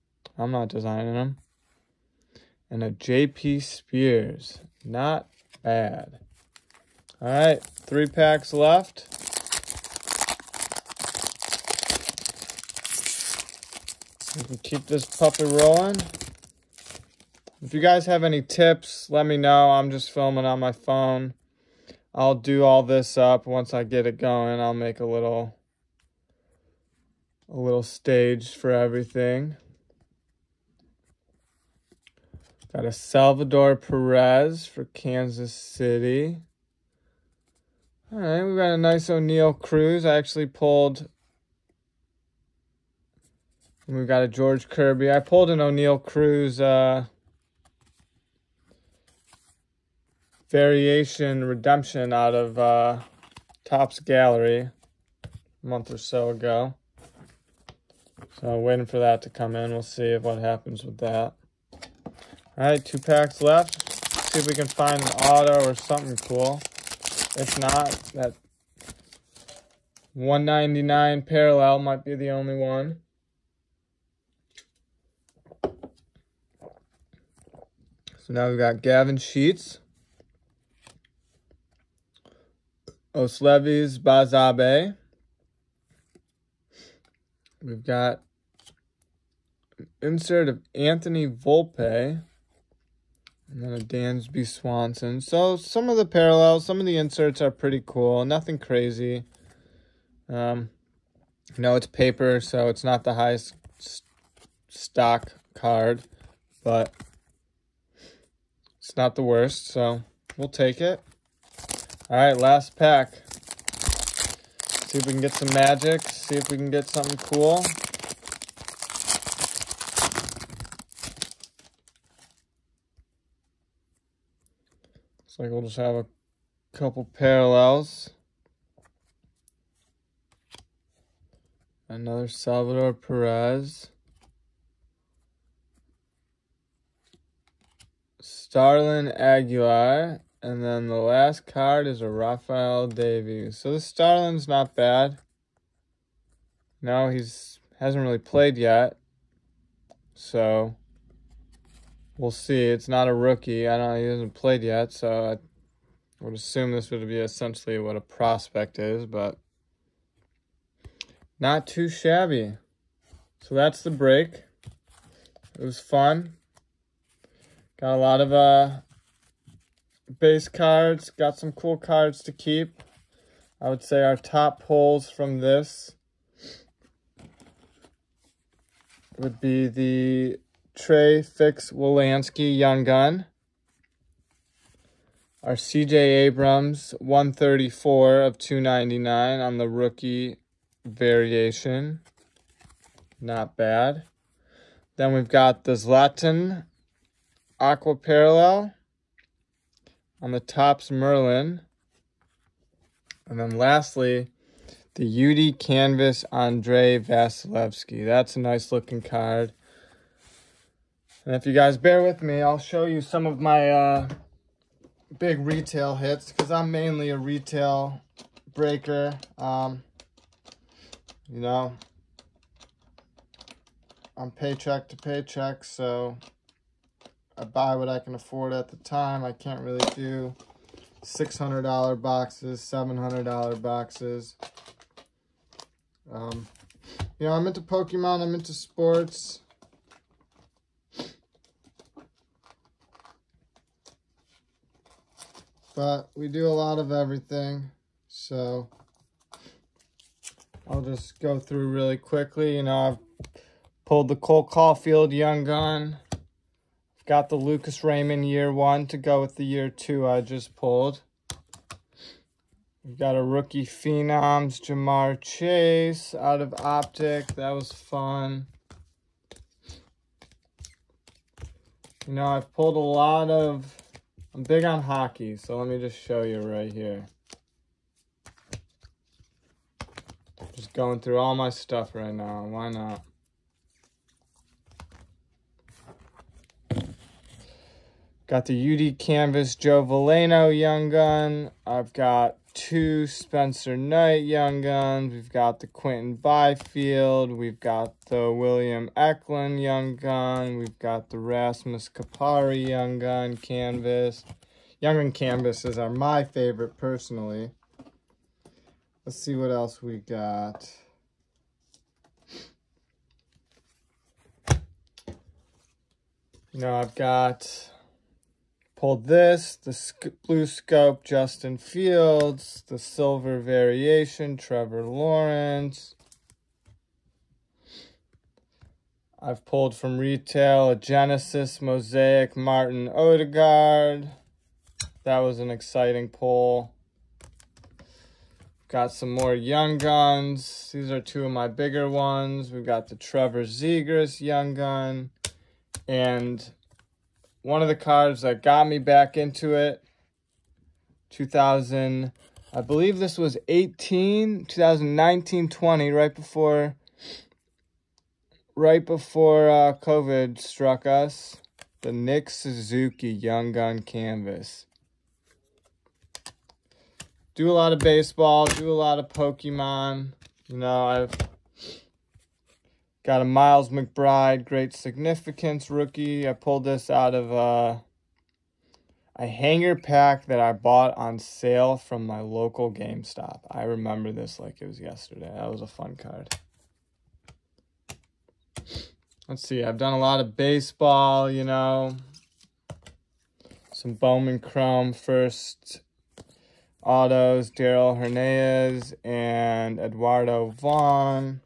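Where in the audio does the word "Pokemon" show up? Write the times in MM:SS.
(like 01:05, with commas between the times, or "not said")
03:57, 06:09.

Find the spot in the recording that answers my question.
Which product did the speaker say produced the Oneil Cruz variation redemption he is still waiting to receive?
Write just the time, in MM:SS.
00:53.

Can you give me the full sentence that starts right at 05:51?
2000, I believe this was 18, 2019, 20, right before, right before uh, COVID struck us.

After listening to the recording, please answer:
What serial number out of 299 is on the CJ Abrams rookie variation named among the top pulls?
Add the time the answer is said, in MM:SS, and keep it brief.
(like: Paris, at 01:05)
134, at 03:07.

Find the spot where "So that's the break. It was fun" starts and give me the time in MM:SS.
02:43.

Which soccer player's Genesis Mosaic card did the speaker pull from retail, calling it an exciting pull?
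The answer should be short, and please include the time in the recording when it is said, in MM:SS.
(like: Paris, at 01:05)
Martin Odegaard, at 05:32.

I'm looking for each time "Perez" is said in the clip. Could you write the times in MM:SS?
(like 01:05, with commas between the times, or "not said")
00:33, 02:12.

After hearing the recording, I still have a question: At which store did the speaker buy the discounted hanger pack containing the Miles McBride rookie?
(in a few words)
GameStop.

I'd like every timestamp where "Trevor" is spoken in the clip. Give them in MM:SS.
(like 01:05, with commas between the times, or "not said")
05:24, 05:42.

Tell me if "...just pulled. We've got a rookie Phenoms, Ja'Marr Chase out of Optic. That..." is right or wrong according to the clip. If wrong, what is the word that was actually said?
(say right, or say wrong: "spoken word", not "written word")
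right.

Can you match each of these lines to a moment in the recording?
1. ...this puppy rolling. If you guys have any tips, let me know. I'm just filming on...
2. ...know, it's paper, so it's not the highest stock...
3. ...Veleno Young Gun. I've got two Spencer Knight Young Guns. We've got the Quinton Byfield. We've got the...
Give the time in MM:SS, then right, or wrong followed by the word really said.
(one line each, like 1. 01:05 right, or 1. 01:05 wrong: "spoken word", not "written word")
1. 00:14 right
2. 01:41 right
3. 04:49 right.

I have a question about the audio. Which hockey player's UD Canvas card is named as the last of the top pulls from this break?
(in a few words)
Andre Vasilevskiy.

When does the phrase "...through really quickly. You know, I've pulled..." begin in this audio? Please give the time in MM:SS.
04:11.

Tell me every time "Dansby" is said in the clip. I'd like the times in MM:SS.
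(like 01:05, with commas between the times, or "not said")
01:33.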